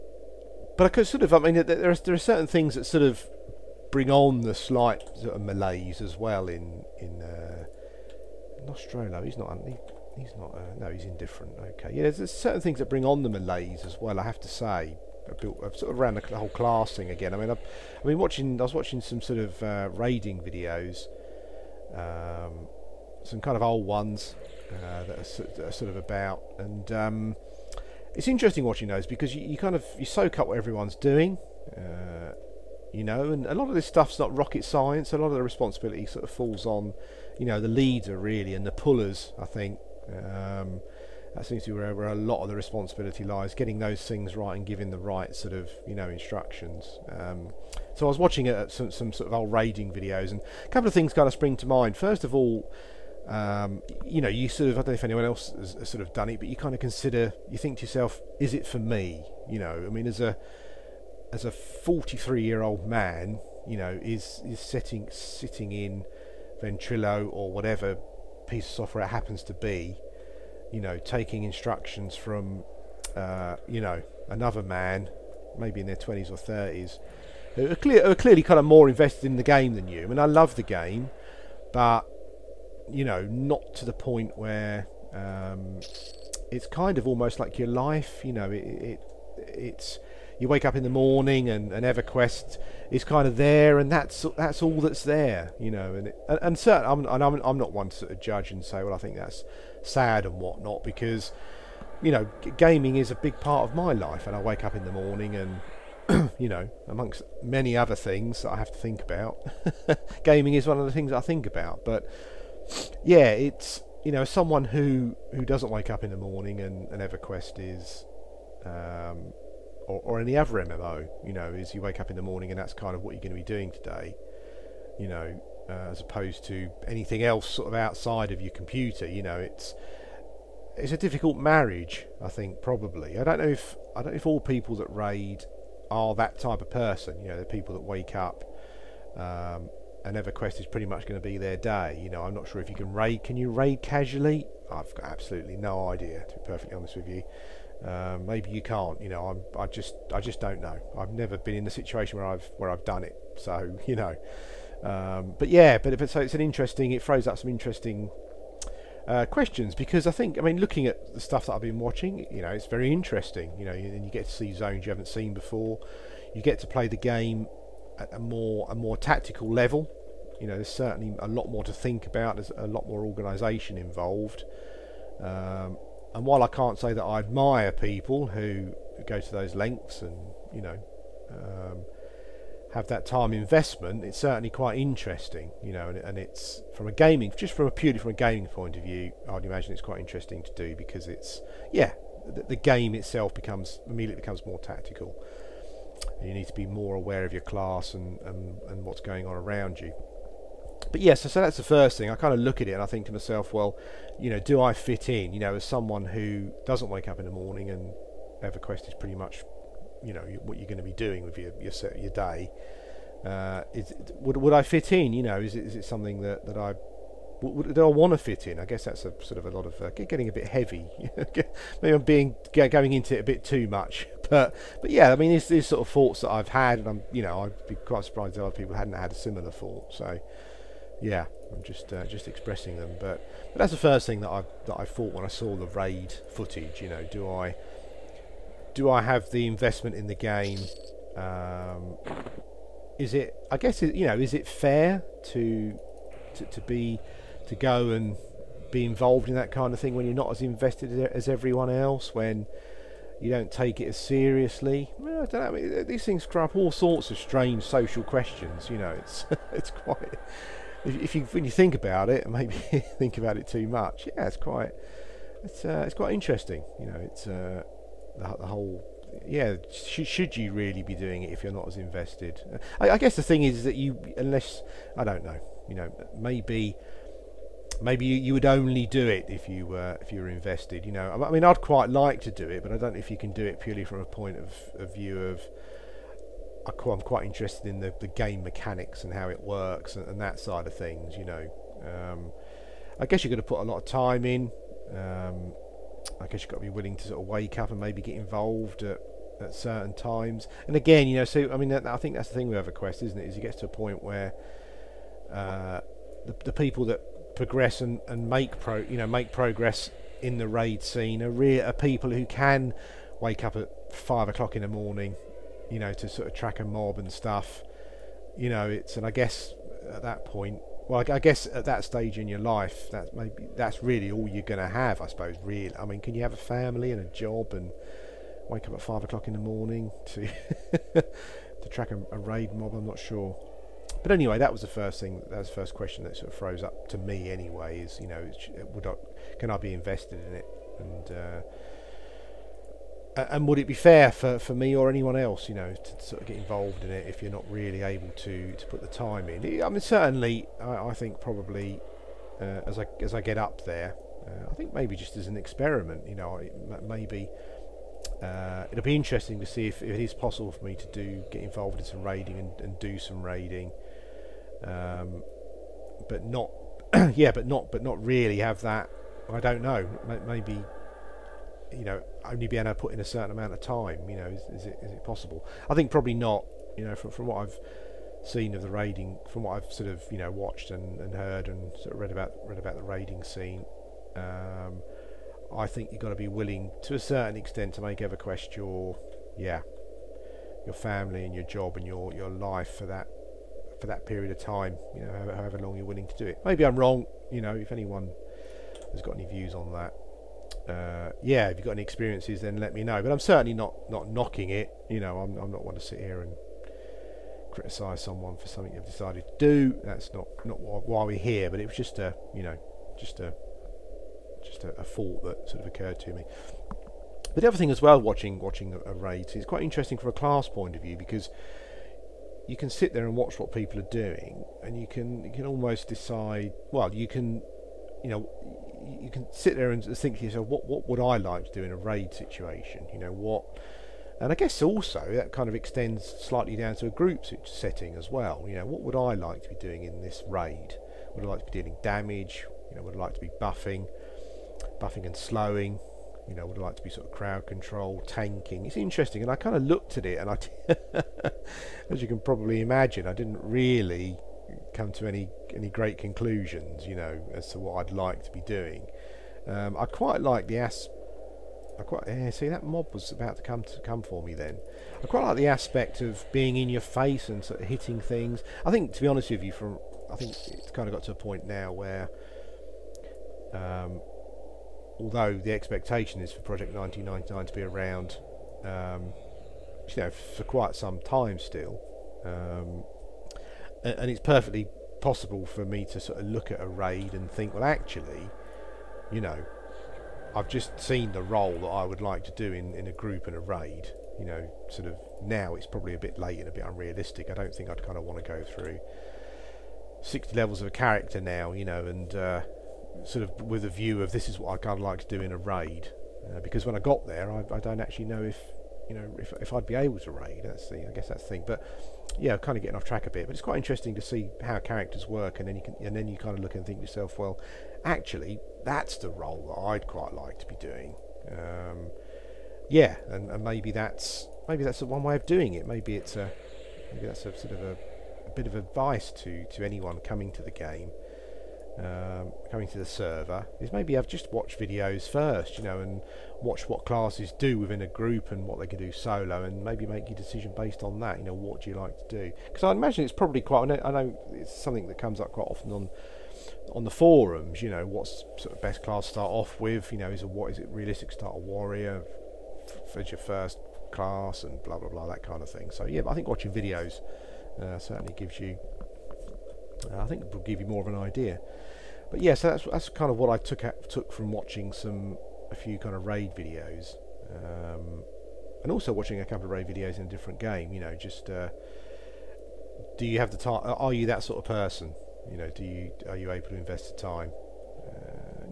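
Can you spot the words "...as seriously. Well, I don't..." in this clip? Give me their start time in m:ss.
4:13.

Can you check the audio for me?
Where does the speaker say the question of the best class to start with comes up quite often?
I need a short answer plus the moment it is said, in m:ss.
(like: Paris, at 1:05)
The forums, at 9:06.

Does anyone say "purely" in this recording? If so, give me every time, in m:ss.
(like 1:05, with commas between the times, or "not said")
3:07, 4:43.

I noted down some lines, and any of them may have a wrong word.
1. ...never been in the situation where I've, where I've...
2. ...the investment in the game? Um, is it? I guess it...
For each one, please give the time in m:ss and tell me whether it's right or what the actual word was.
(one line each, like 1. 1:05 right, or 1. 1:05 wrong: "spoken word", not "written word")
1. 2:31 right
2. 3:59 right.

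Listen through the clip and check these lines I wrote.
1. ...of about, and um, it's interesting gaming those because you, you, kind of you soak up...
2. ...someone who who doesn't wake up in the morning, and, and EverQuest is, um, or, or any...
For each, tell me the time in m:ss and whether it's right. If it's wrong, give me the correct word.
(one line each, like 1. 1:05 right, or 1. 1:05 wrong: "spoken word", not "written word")
1. 0:25 wrong: "watching", not "gaming"
2. 1:54 right.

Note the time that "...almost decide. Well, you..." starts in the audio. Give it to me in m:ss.
7:05.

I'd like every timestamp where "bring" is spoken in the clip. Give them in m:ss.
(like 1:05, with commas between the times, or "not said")
0:03, 0:12.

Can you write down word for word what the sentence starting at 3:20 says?
But yes, yeah, so, so that's the first thing.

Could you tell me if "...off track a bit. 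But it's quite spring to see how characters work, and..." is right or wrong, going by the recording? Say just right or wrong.
wrong.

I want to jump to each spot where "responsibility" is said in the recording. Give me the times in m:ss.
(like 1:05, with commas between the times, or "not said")
0:35, 0:42.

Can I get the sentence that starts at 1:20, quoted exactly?
I mean, I love the game, but you know, not to the point where um, it's kind of almost like your life.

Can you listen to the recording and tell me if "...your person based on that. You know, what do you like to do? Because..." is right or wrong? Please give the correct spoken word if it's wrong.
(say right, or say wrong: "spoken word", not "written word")
wrong: "decision", not "person".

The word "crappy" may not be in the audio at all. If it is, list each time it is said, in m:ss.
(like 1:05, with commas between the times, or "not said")
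not said.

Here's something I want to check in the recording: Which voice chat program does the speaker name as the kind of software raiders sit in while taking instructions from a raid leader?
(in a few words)
Ventrilo.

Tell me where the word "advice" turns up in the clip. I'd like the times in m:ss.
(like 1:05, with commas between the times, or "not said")
8:48.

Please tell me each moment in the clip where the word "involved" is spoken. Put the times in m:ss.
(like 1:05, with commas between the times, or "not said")
2:53, 4:08, 4:58, 5:46, 6:01.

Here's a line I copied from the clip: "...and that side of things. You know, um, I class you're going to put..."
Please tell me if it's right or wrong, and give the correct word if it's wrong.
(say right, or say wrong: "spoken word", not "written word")
wrong: "guess", not "class".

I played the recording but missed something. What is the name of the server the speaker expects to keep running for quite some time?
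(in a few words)
Project 1999.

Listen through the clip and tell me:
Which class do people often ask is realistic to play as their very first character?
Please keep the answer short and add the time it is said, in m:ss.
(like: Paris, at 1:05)
Warrior, at 9:11.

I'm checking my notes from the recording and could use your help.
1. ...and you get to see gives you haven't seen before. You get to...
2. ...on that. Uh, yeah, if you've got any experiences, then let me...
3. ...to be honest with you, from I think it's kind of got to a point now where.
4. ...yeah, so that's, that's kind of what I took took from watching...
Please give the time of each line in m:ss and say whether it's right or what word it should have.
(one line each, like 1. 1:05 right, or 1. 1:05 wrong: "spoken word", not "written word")
1. 2:43 wrong: "zones", not "gives"
2. 6:39 right
3. 7:48 right
4. 9:22 right.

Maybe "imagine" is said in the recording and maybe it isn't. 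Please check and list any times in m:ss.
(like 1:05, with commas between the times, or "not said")
3:09, 7:32, 9:02.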